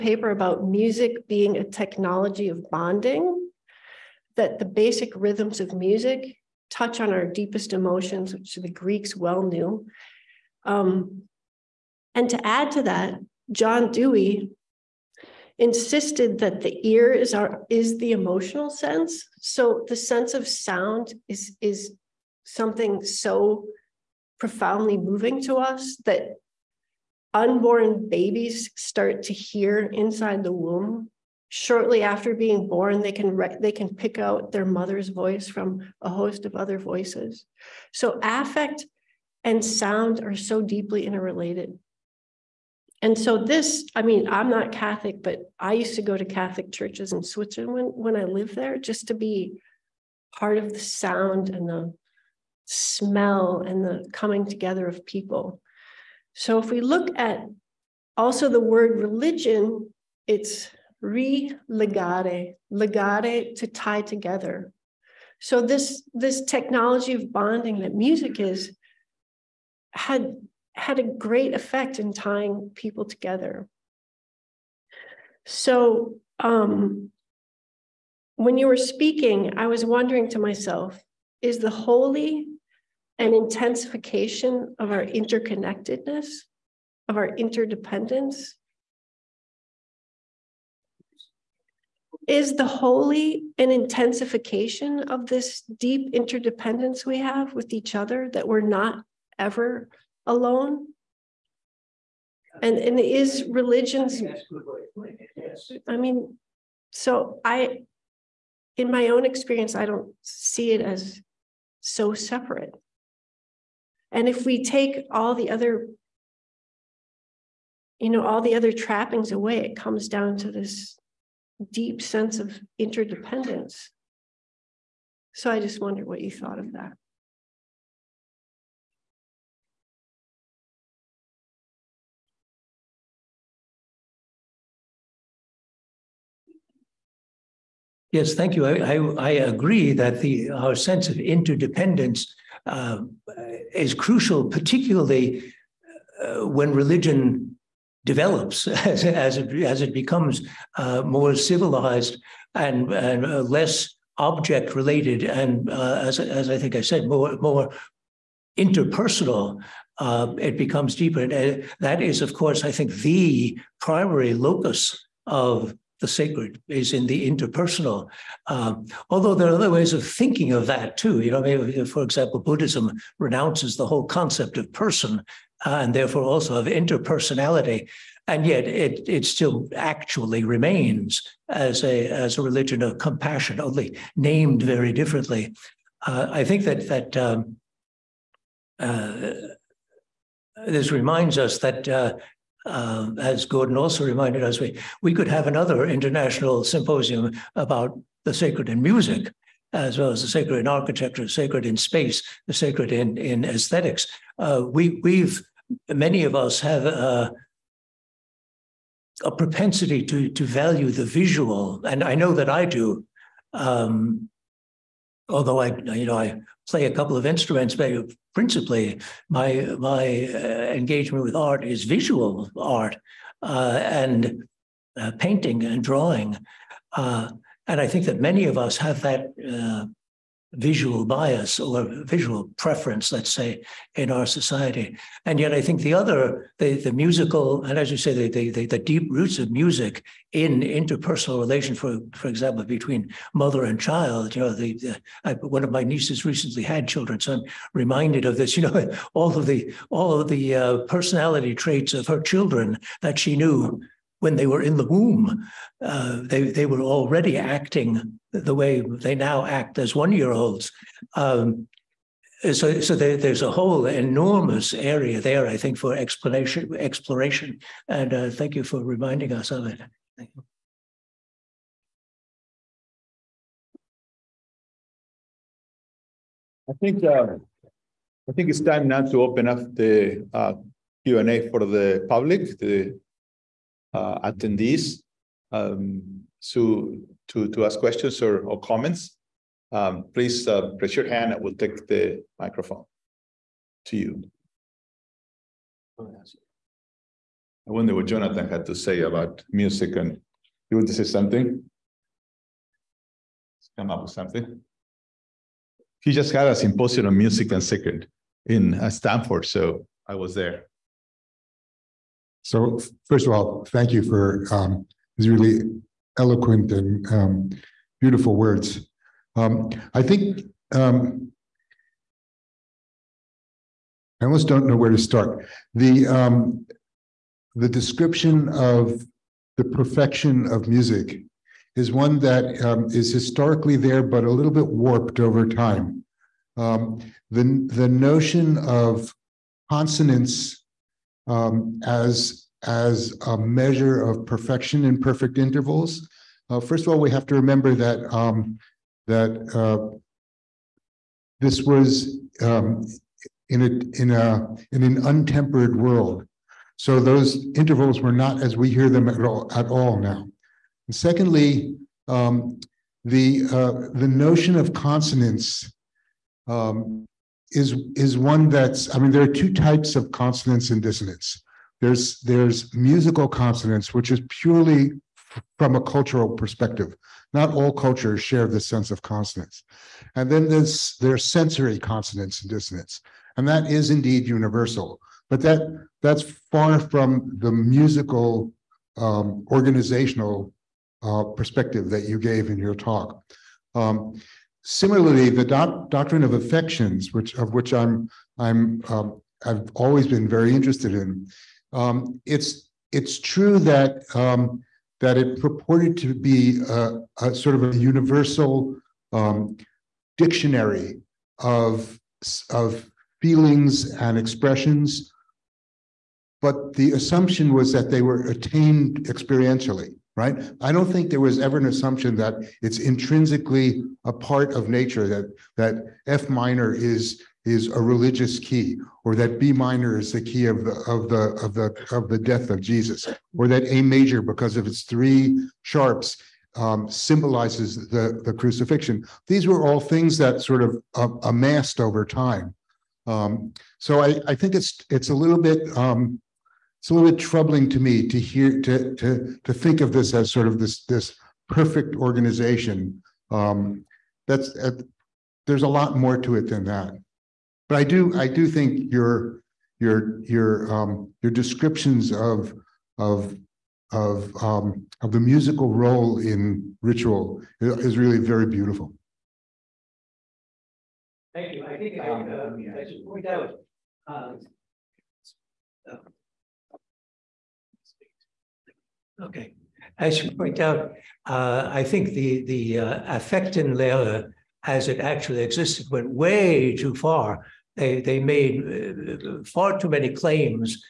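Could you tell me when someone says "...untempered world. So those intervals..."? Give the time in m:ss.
5:55.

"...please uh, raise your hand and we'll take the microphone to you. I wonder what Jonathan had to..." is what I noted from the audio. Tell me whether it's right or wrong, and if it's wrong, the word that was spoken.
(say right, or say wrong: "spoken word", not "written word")
right.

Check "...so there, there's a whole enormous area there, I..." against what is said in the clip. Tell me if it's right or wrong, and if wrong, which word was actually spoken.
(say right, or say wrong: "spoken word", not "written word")
right.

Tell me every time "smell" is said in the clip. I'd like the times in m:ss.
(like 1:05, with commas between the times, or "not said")
0:52.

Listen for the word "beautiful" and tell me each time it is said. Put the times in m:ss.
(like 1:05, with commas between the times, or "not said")
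5:17, 7:48.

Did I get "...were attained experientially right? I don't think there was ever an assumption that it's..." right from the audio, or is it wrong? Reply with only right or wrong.
right.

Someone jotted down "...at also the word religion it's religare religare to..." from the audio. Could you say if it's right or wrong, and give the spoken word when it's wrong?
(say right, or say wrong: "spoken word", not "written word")
wrong: "legare", not "religare".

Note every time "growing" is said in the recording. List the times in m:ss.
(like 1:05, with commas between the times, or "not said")
not said.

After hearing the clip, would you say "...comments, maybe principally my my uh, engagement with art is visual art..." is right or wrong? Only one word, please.
wrong.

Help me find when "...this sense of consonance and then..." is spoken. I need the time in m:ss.
6:18.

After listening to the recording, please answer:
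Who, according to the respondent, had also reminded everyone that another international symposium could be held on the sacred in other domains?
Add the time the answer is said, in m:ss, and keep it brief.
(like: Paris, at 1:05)
Gordon, at 3:13.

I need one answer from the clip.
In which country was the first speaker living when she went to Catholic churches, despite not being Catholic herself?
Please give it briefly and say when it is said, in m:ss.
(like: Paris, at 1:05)
Switzerland, at 0:47.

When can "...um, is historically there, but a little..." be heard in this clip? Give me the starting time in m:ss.
5:32.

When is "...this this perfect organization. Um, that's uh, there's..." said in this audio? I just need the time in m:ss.
7:30.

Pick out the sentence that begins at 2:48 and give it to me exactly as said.
Um, although there are other ways of thinking of that too.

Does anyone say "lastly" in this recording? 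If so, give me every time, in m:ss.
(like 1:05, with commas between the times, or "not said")
not said.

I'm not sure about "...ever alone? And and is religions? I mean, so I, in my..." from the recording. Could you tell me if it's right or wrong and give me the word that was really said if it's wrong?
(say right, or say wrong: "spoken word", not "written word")
right.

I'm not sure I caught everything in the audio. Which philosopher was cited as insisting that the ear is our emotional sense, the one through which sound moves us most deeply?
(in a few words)
John Dewey.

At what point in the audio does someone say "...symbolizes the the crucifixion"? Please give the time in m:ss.
7:16.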